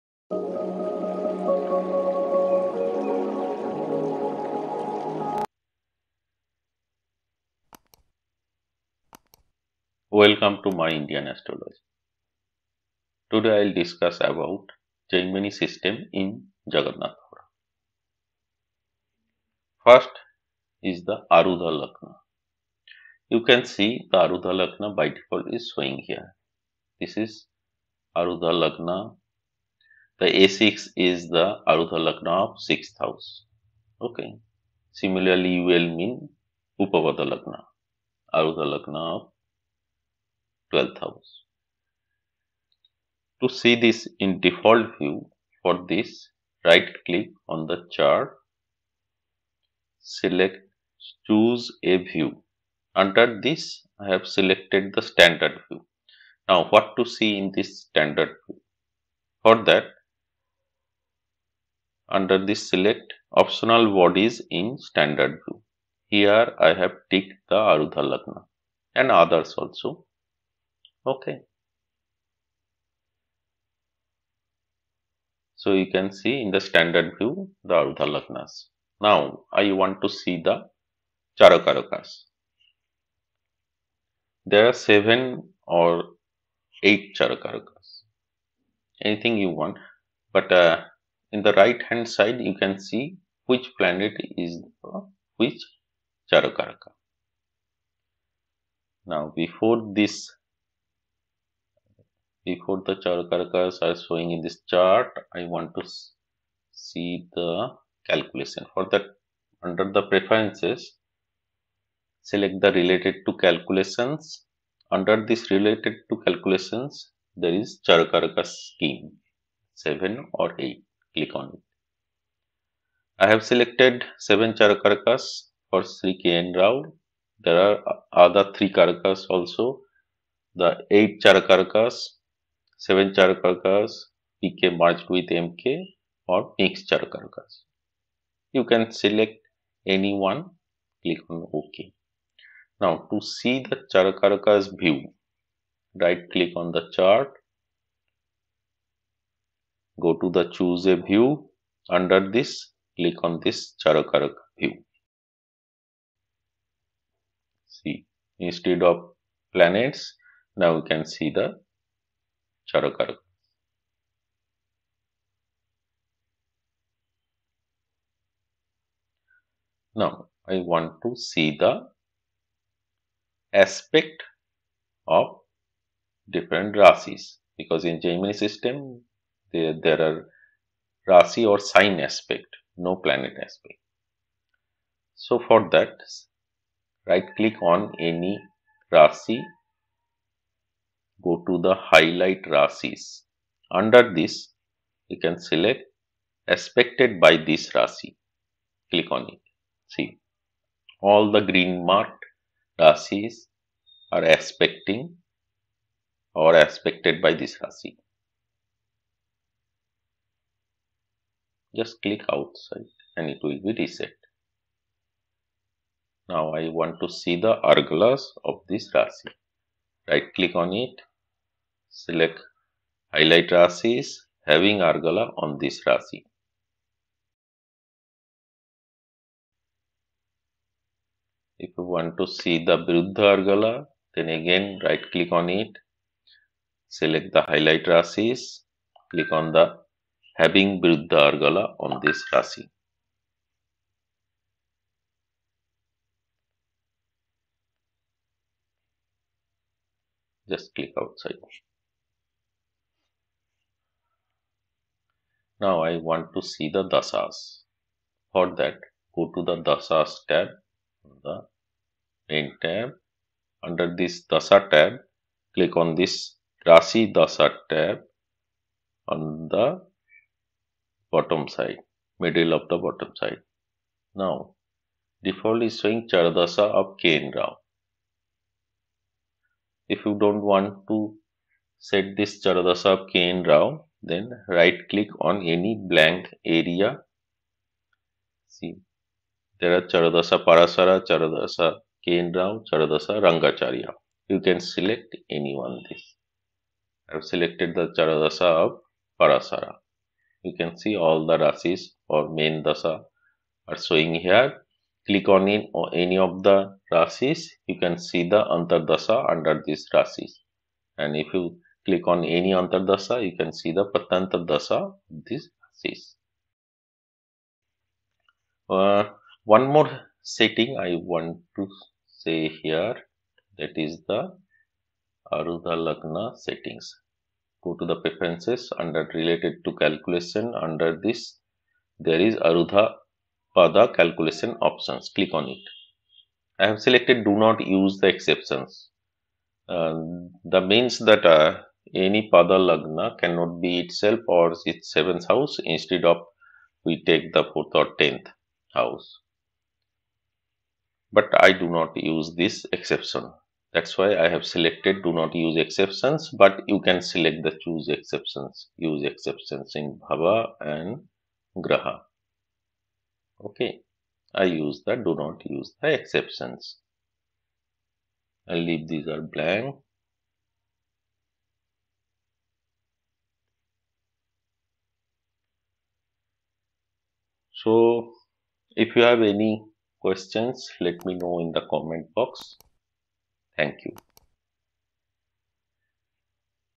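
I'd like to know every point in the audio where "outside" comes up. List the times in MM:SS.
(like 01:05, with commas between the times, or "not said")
03:32, 04:10.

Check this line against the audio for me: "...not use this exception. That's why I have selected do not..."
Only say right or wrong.
right.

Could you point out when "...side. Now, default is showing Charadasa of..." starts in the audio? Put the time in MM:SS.
04:33.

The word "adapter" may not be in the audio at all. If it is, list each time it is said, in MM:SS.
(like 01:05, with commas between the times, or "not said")
not said.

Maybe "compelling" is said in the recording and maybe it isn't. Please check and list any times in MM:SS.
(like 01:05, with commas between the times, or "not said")
not said.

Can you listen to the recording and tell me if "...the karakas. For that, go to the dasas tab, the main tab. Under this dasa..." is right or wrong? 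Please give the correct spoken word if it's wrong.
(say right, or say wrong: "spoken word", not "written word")
wrong: "dasas", not "karakas".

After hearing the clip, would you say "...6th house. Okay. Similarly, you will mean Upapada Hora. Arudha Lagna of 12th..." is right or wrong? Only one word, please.
wrong.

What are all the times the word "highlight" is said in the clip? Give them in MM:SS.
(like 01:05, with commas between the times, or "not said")
03:11, 03:43, 03:57.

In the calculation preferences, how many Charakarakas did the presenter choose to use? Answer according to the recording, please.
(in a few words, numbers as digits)
7.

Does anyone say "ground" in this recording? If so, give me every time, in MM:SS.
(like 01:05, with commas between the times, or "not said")
not said.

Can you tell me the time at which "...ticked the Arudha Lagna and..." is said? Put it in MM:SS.
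01:07.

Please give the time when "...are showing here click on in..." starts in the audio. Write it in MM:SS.
05:03.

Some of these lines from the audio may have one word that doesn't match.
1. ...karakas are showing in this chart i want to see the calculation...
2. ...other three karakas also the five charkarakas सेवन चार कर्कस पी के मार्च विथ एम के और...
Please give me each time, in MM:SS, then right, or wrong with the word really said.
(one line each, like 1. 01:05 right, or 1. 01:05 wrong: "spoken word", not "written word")
1. 01:43 right
2. 02:08 wrong: "eight", not "five".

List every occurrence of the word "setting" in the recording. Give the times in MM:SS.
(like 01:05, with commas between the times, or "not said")
05:20, 05:26.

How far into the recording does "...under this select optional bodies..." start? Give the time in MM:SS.
01:02.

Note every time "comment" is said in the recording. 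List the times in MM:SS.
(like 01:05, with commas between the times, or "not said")
06:21.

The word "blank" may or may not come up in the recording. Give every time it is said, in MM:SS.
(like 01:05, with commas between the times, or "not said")
04:45, 06:09.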